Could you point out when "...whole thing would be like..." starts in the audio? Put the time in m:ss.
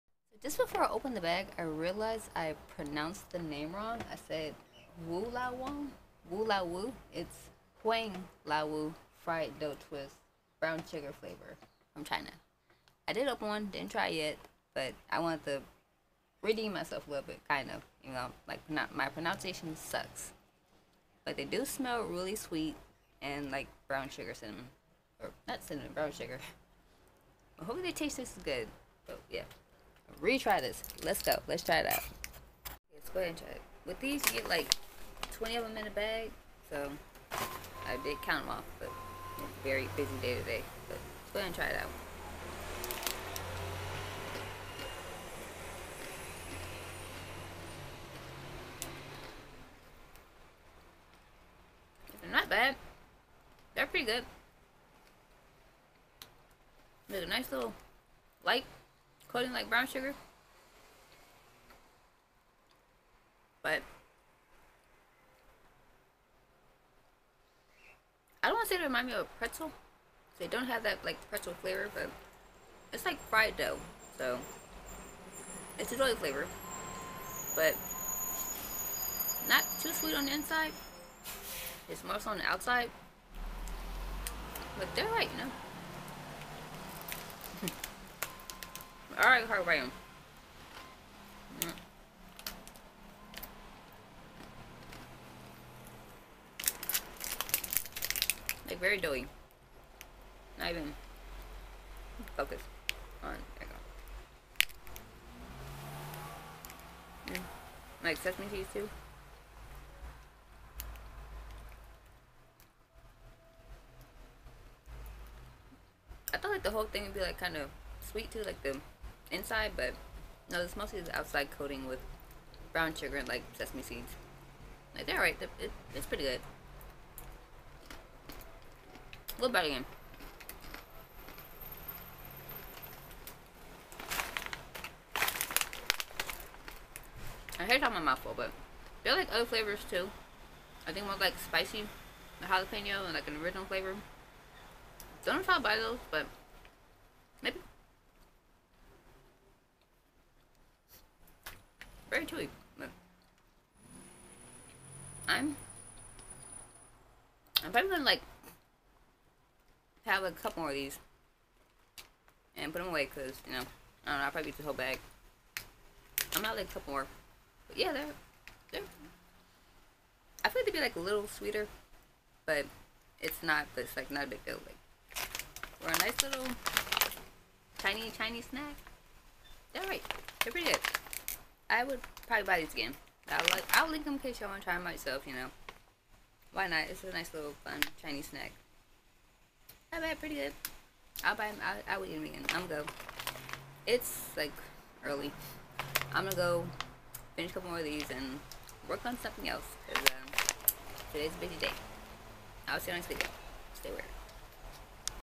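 1:56.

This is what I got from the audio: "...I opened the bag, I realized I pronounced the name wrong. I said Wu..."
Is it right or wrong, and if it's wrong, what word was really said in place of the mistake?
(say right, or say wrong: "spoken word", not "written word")
right.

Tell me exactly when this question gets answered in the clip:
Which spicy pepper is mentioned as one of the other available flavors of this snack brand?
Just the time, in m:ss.
2:22.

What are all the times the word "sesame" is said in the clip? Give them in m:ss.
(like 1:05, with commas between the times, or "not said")
1:48, 2:03.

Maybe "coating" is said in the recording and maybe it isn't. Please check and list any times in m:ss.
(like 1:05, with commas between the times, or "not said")
0:59, 2:01.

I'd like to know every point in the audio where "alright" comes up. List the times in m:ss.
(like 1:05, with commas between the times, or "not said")
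1:29, 2:05.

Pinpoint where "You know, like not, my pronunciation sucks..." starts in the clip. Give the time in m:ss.
0:18.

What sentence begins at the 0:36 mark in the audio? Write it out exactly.
So I did count them off, but it's a very busy day today.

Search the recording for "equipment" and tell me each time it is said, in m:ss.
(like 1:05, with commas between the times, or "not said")
2:32.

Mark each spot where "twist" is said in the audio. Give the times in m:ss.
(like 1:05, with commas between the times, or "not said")
0:09.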